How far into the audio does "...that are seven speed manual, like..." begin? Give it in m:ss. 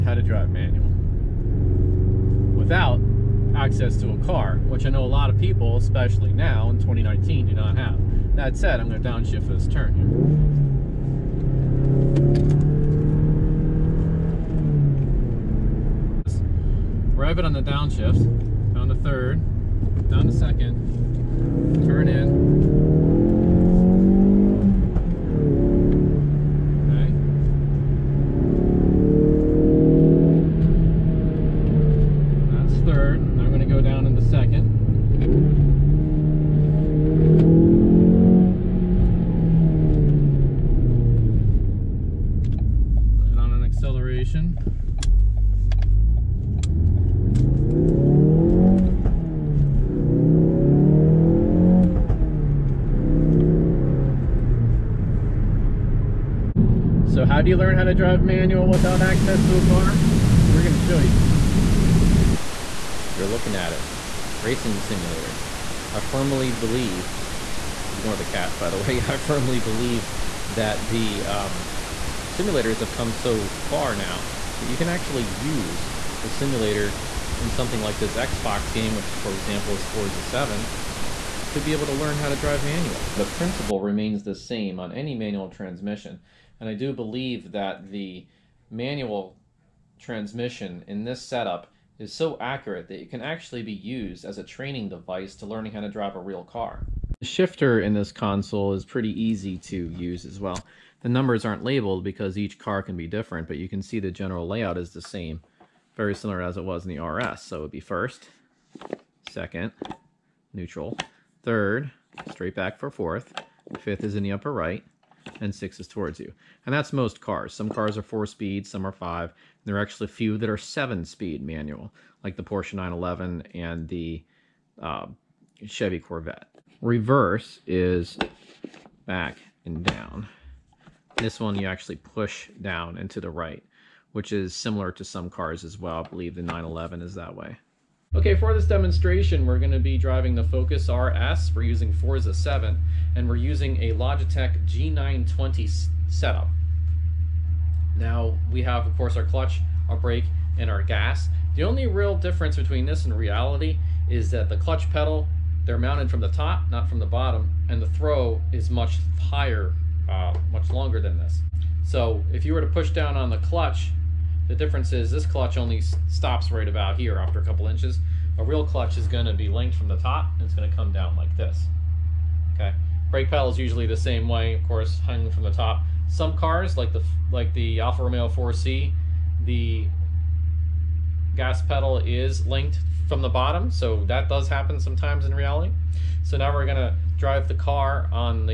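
2:00.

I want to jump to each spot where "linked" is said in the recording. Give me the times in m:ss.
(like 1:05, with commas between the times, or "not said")
2:49, 3:02.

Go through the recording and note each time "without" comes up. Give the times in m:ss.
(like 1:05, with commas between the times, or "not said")
0:02, 0:58.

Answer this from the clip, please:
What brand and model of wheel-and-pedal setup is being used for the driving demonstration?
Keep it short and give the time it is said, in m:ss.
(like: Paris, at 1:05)
Logitech G920, at 2:23.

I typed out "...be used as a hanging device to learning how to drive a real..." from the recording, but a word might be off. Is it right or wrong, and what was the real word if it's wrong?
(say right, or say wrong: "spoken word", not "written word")
wrong: "training", not "hanging".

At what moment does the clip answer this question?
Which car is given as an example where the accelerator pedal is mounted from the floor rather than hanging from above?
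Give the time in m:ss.
2:57.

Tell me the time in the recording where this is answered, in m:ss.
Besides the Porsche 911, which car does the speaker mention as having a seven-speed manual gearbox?
2:05.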